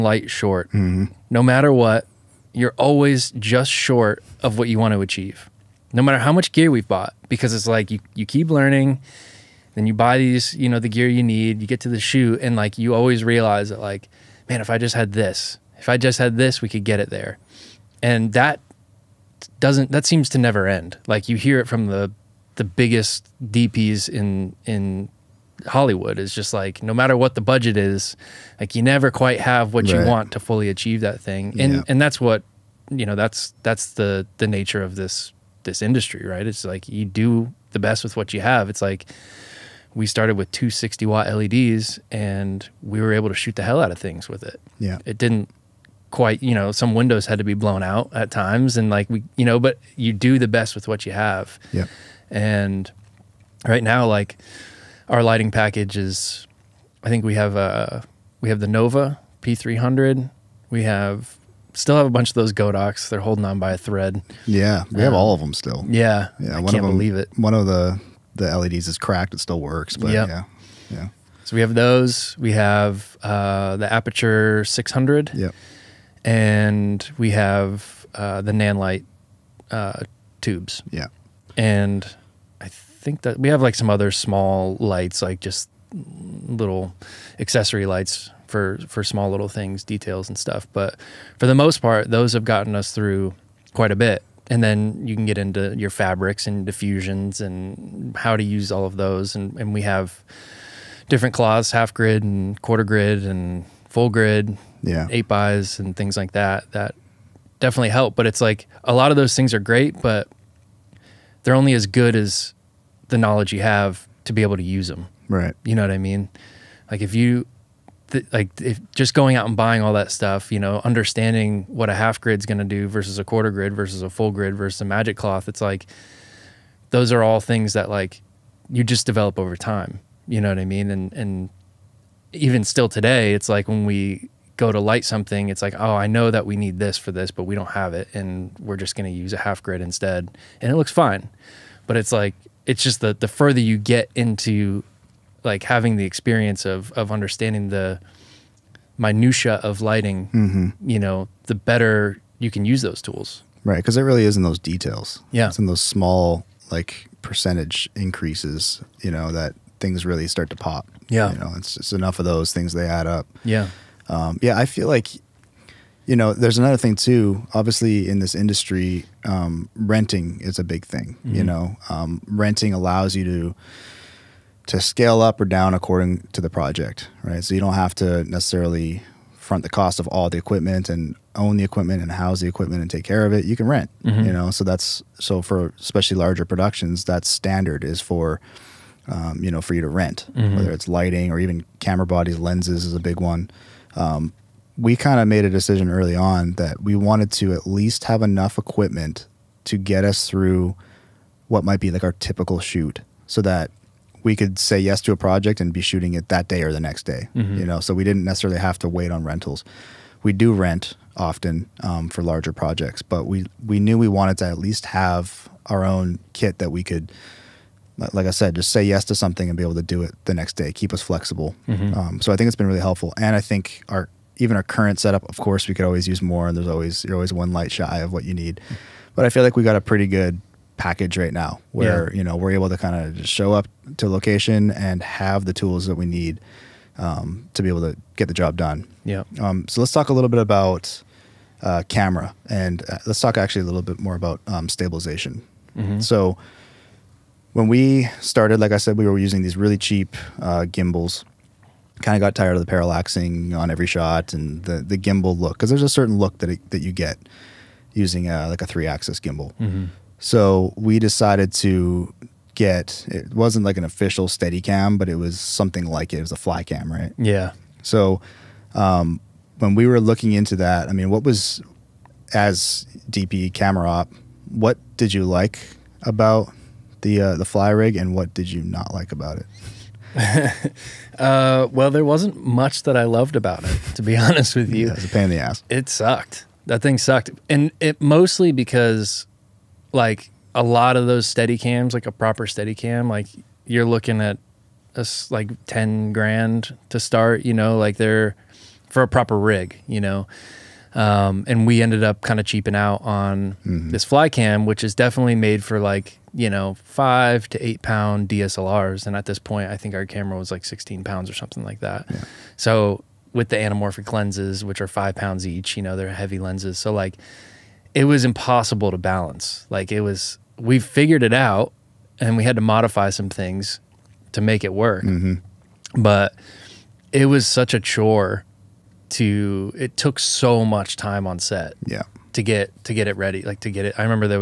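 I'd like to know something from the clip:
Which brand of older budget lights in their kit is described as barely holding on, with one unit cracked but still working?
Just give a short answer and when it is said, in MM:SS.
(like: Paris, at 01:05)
Godox, at 01:02.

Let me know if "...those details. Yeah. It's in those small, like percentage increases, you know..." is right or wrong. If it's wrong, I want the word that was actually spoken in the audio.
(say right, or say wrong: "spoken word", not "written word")
right.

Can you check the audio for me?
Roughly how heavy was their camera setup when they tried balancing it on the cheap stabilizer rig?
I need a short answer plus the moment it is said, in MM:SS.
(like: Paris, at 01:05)
16 pounds, at 05:10.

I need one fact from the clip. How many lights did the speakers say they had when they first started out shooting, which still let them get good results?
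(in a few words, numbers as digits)
2.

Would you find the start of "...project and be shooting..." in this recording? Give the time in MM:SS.
03:25.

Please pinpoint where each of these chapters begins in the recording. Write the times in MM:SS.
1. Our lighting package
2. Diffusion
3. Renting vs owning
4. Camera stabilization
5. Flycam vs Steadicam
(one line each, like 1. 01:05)
1. 00:53
2. 01:33
3. 02:43
4. 04:02
5. 04:41.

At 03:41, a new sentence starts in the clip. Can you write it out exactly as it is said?
Um, so I think it's been really helpful.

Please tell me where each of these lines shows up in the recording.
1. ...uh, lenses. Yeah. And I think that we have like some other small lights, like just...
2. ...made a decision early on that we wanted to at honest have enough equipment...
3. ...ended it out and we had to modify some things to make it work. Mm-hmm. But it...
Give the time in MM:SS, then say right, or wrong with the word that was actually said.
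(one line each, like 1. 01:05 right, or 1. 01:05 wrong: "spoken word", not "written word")
1. 01:19 wrong: "tubes", not "lenses"
2. 03:15 wrong: "least", not "honest"
3. 05:20 wrong: "figured", not "ended".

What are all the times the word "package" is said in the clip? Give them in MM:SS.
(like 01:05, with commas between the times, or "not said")
00:55, 03:50.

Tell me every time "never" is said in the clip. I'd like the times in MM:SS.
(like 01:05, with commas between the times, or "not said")
00:20, 00:28.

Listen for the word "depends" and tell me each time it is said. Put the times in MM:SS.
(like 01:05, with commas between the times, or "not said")
not said.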